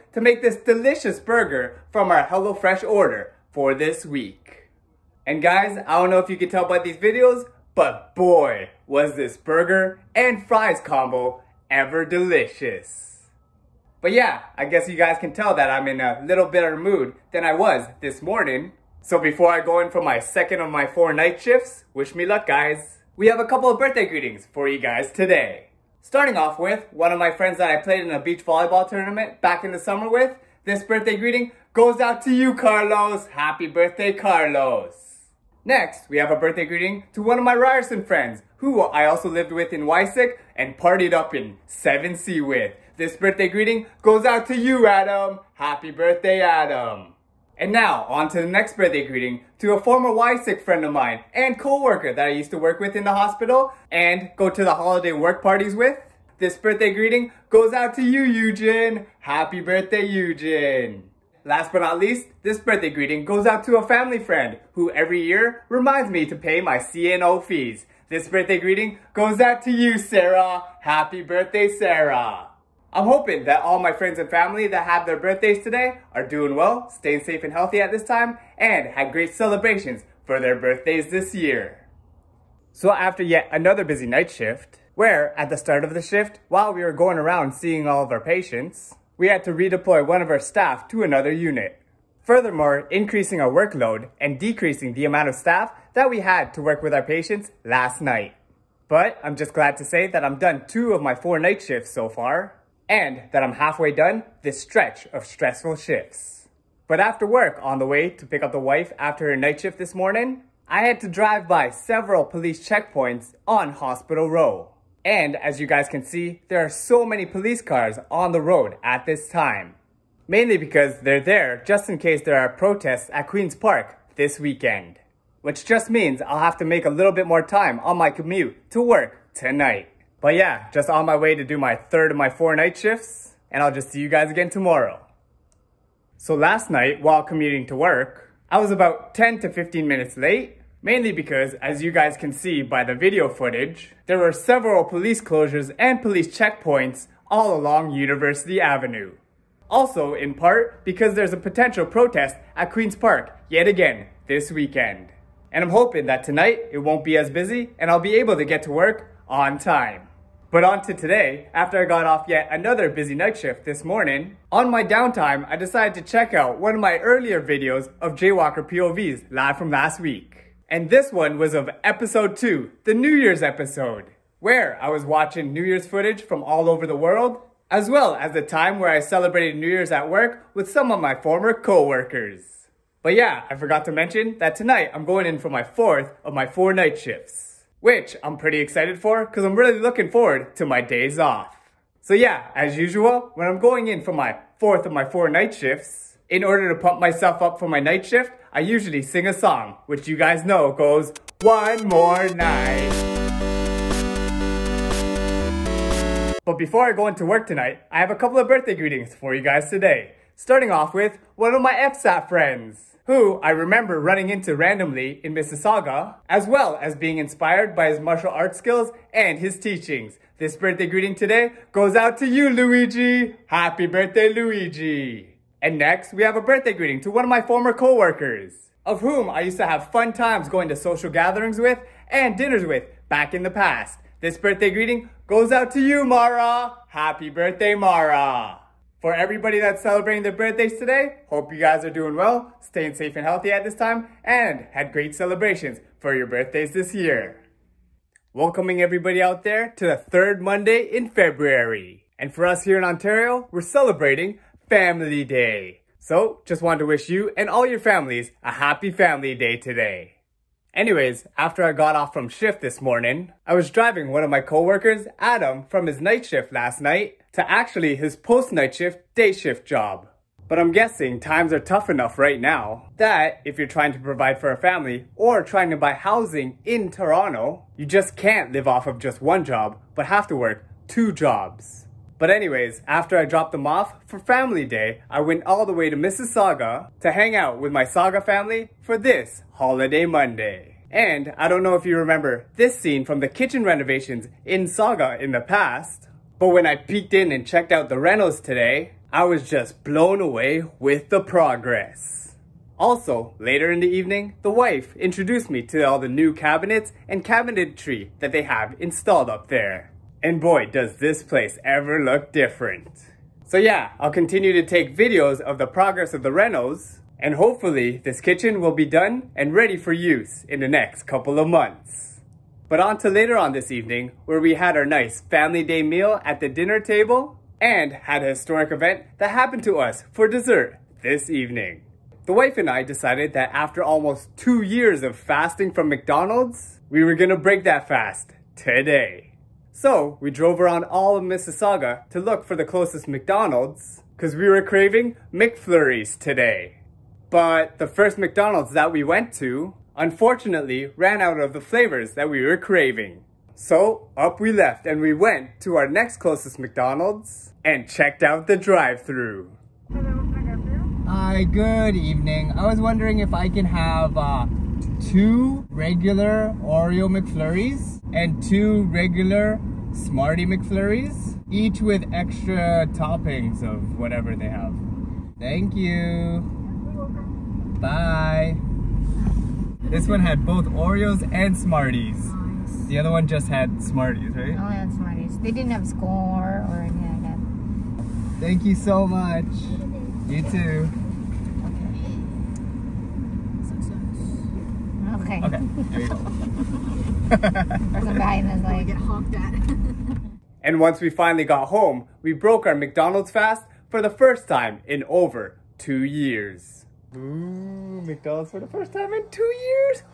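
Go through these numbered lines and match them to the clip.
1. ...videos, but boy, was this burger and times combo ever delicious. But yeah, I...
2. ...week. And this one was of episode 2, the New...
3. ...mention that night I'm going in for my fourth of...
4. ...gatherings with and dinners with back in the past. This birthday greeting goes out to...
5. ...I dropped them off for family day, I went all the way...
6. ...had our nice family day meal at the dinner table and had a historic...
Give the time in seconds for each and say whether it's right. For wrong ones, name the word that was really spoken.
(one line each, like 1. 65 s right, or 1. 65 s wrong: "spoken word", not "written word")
1. 6 s wrong: "fries", not "times"
2. 170 s right
3. 183 s wrong: "tonight", not "night"
4. 231 s right
5. 283 s right
6. 324 s right.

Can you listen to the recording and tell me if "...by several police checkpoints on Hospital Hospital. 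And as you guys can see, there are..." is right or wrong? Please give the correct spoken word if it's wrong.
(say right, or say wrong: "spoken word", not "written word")
wrong: "Row", not "Hospital".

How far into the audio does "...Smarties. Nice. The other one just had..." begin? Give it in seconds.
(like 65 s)
381 s.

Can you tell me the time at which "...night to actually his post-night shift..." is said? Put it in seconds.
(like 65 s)
266 s.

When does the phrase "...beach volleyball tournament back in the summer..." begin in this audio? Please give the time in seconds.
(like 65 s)
28 s.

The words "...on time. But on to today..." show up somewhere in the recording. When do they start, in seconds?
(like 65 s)
159 s.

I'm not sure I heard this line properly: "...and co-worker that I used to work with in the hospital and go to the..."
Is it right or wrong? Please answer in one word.
right.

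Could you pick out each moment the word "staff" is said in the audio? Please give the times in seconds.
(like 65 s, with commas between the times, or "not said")
90 s, 95 s.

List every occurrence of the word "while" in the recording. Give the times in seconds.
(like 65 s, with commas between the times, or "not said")
86 s, 137 s.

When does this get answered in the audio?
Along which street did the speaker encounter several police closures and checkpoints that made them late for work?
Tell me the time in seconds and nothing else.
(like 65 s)
147 s.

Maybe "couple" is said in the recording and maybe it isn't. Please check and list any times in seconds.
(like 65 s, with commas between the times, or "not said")
23 s, 208 s, 321 s.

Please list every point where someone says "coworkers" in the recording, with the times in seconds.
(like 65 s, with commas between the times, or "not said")
227 s, 264 s.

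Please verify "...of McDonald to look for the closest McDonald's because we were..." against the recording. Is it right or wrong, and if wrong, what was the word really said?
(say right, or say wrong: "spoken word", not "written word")
wrong: "Mississauga", not "McDonald".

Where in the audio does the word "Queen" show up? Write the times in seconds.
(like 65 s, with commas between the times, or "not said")
123 s, 152 s.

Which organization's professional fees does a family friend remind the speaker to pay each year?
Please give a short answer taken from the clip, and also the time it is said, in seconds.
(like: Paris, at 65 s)
CNO, at 66 s.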